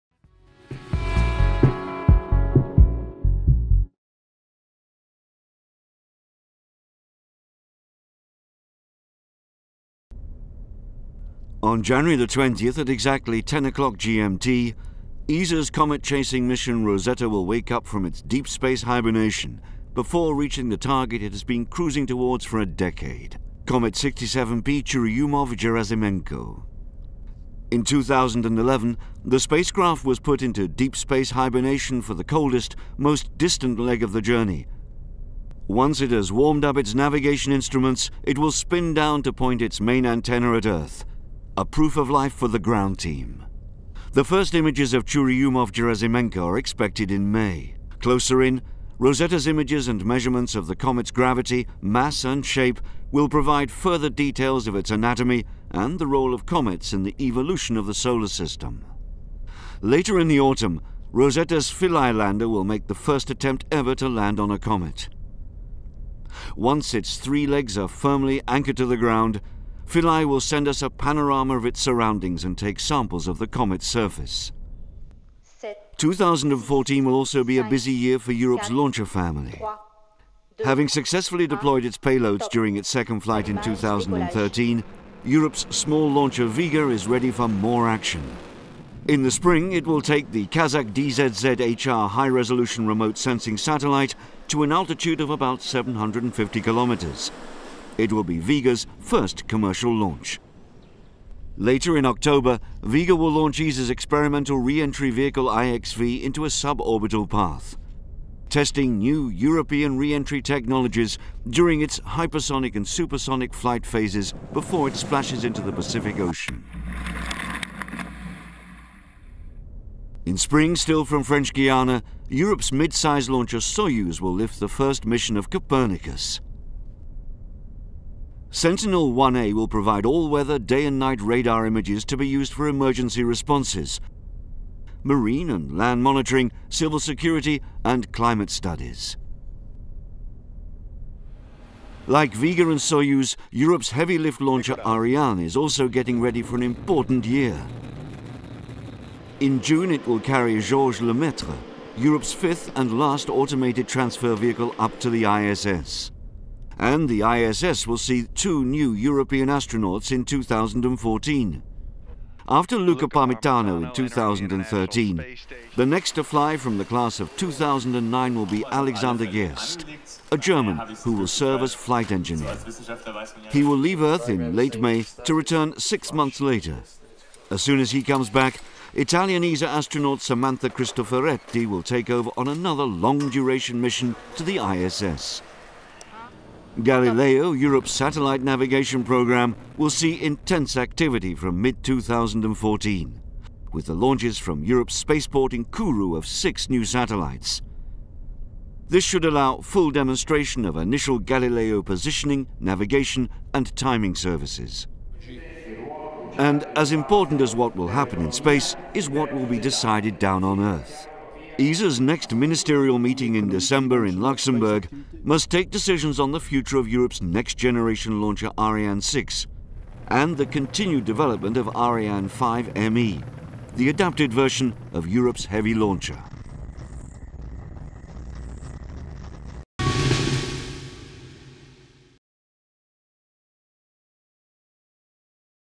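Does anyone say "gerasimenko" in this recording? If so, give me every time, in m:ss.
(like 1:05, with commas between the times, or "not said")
0:24, 0:45.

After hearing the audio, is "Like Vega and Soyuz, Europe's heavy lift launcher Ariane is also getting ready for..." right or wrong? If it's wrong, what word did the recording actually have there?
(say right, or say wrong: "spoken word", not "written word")
right.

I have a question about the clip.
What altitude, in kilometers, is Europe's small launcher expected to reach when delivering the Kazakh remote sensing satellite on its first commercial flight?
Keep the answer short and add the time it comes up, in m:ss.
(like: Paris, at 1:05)
750, at 1:35.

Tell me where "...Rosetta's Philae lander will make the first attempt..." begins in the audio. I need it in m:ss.
1:01.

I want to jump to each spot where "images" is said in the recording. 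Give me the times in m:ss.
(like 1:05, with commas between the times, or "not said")
0:44, 0:49, 2:11.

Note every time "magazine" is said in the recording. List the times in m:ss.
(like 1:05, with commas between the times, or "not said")
not said.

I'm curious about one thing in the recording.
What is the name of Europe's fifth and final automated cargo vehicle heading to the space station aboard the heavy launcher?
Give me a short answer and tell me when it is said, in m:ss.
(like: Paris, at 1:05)
Georges Lemaitre, at 2:30.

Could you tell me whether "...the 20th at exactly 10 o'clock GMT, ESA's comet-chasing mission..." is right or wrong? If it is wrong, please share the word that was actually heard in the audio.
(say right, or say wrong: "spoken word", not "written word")
right.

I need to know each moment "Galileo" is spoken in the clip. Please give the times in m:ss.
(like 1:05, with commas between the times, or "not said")
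3:06, 3:21.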